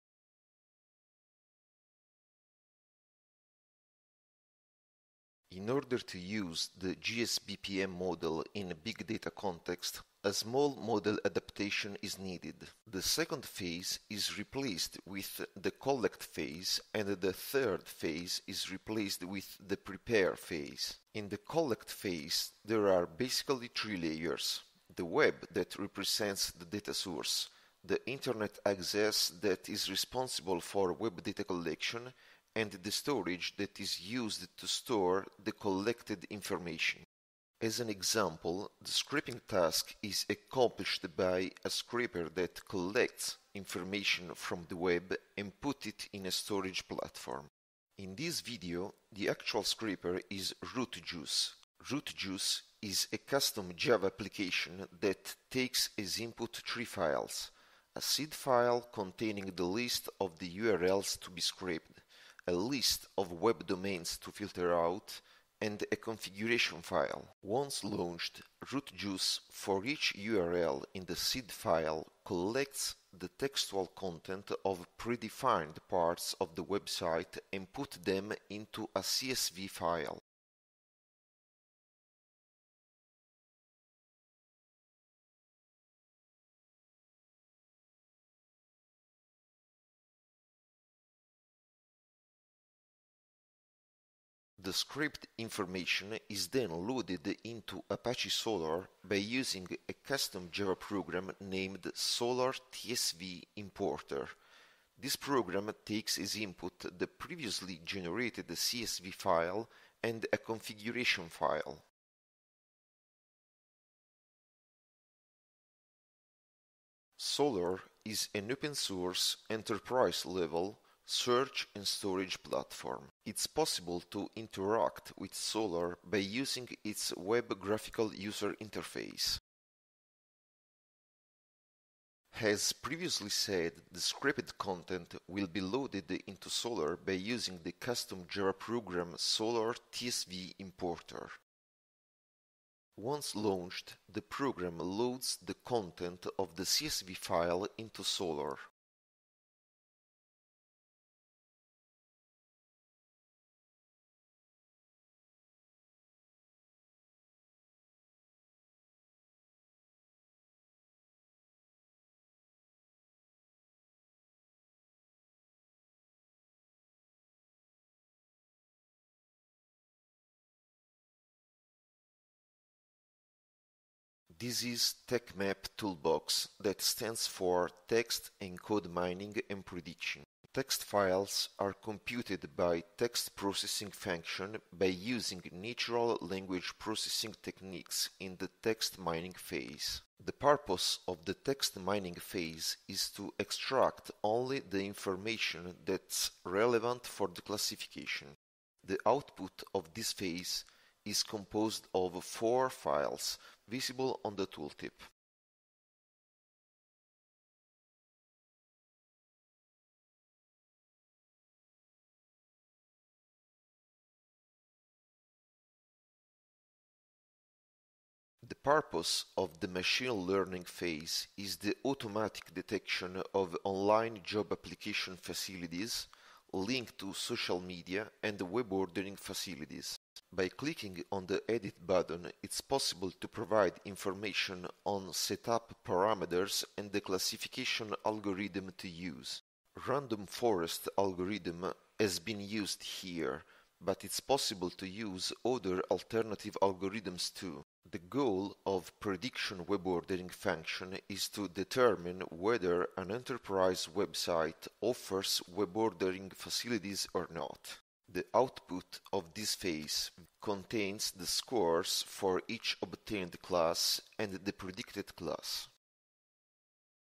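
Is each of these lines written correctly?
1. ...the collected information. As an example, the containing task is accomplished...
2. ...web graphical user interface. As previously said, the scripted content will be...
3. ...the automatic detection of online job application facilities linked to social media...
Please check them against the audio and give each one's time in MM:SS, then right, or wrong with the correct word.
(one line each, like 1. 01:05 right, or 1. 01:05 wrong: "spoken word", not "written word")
1. 00:35 wrong: "scraping", not "containing"
2. 02:07 right
3. 03:41 right.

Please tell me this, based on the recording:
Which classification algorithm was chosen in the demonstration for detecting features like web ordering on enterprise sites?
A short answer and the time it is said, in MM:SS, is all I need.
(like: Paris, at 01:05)
Random forest, at 03:59.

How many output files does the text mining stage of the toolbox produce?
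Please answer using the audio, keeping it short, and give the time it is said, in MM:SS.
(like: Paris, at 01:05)
4, at 03:22.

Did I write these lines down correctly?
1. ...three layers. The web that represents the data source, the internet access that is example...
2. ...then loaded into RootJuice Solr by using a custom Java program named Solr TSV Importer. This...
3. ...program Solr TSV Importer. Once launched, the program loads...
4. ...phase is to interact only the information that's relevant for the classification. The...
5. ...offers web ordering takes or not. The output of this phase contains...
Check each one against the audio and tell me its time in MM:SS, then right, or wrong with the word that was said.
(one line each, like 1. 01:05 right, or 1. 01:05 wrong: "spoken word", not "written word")
1. 00:23 wrong: "responsible", not "example"
2. 01:36 wrong: "Apache", not "RootJuice"
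3. 02:18 right
4. 03:12 wrong: "extract", not "interact"
5. 04:14 wrong: "facilities", not "takes".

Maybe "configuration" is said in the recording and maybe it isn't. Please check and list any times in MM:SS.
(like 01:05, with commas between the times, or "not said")
01:05, 01:50.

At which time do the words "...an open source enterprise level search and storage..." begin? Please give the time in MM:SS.
01:58.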